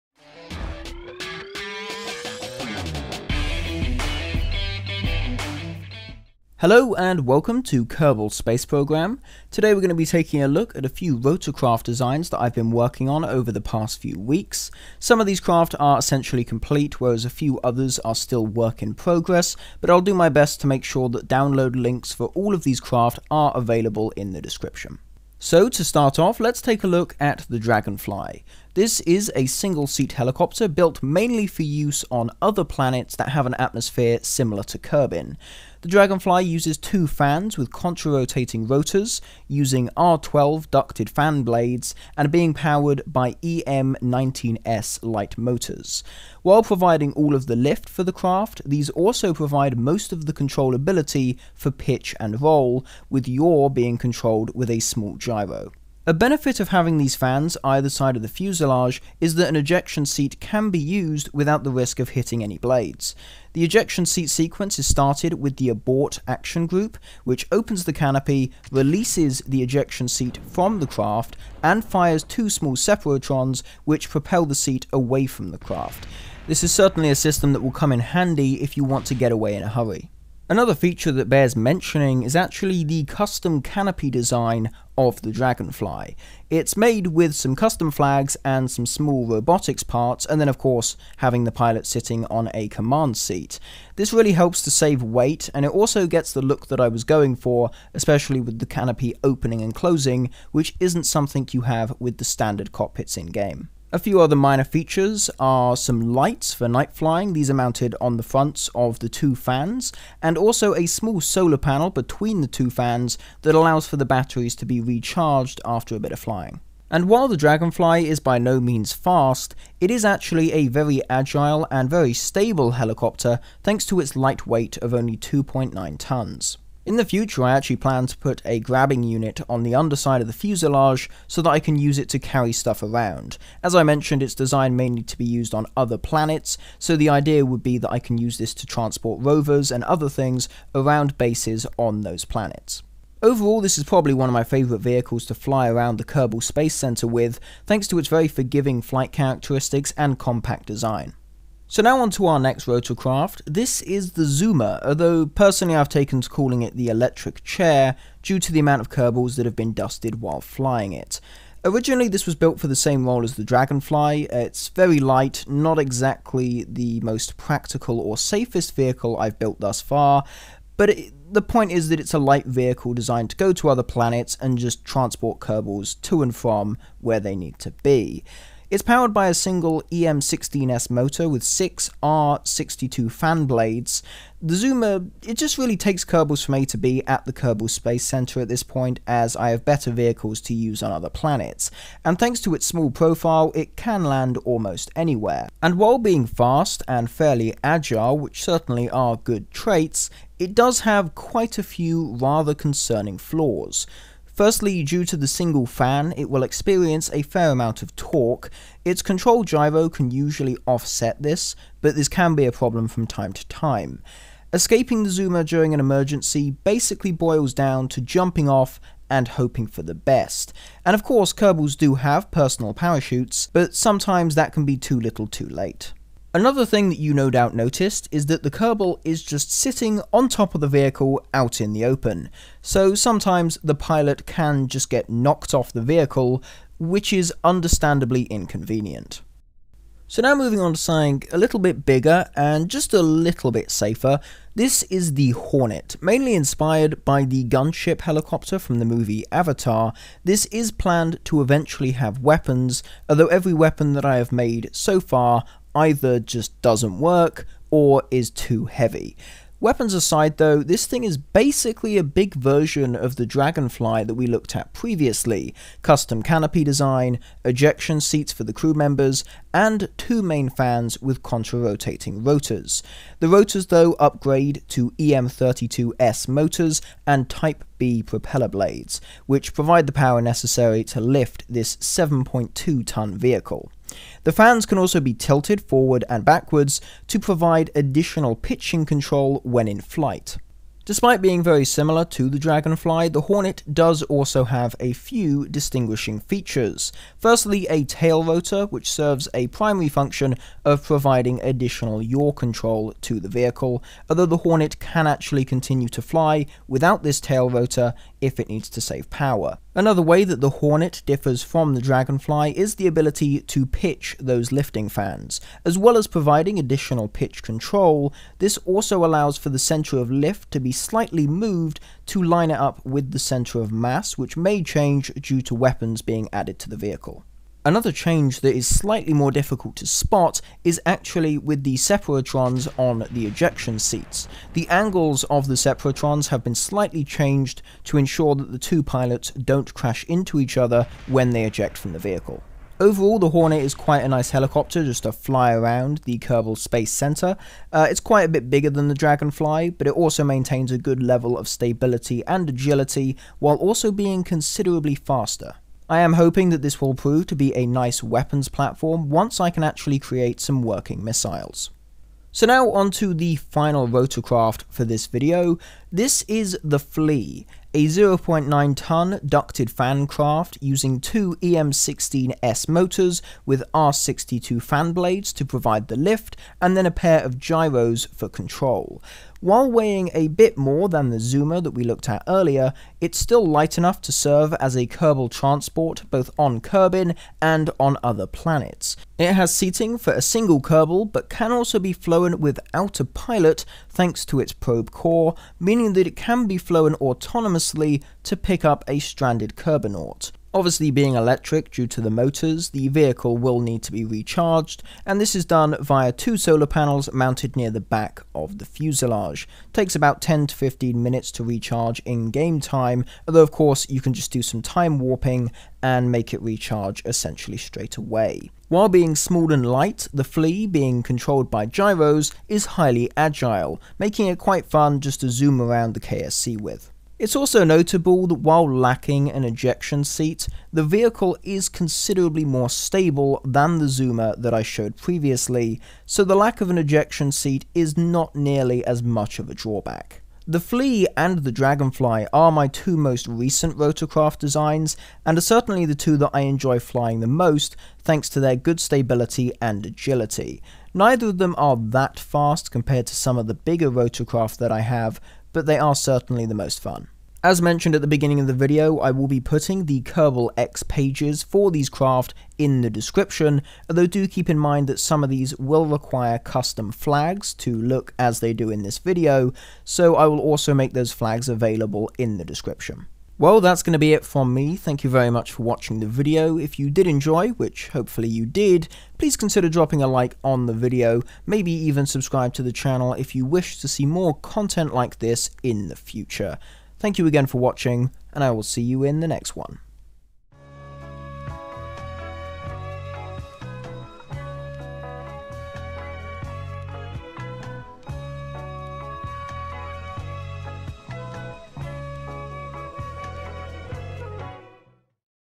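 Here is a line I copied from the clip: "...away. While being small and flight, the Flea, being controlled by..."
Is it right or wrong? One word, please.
wrong.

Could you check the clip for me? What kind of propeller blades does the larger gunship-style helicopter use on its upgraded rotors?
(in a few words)
Type B.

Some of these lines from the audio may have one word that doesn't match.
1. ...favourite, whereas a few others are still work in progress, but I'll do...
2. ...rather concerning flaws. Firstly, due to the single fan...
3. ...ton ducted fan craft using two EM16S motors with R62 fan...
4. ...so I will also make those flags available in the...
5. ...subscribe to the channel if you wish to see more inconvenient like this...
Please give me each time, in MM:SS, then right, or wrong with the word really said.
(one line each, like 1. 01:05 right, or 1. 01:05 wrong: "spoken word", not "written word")
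1. 00:16 wrong: "complete", not "favourite"
2. 03:22 right
3. 06:08 right
4. 07:49 right
5. 08:02 wrong: "content", not "inconvenient".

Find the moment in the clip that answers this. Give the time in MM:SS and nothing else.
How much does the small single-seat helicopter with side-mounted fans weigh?
02:05.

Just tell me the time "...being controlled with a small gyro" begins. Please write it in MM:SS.
00:53.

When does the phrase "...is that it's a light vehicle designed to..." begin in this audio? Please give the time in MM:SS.
02:51.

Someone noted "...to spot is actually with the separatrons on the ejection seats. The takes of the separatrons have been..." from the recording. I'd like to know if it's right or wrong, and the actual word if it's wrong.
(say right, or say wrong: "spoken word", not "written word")
wrong: "angles", not "takes".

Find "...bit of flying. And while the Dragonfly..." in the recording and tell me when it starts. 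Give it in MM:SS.
01:55.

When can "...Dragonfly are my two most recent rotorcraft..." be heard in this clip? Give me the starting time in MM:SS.
07:21.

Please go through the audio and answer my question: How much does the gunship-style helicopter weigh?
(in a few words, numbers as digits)
7.2 tons.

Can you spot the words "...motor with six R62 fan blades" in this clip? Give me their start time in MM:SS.
03:00.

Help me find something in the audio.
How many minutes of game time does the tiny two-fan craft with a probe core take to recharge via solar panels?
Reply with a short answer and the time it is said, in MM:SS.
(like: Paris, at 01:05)
10 to 15 minutes, at 06:50.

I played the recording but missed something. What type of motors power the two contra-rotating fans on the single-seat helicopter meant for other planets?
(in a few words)
EM19S light motors.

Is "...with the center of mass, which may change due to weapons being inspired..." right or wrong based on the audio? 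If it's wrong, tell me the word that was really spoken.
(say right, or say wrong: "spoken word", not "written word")
wrong: "added", not "inspired".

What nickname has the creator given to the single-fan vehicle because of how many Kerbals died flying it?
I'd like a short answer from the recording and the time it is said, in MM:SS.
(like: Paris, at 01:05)
the electric chair, at 02:36.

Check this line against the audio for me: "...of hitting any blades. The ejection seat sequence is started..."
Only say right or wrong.
right.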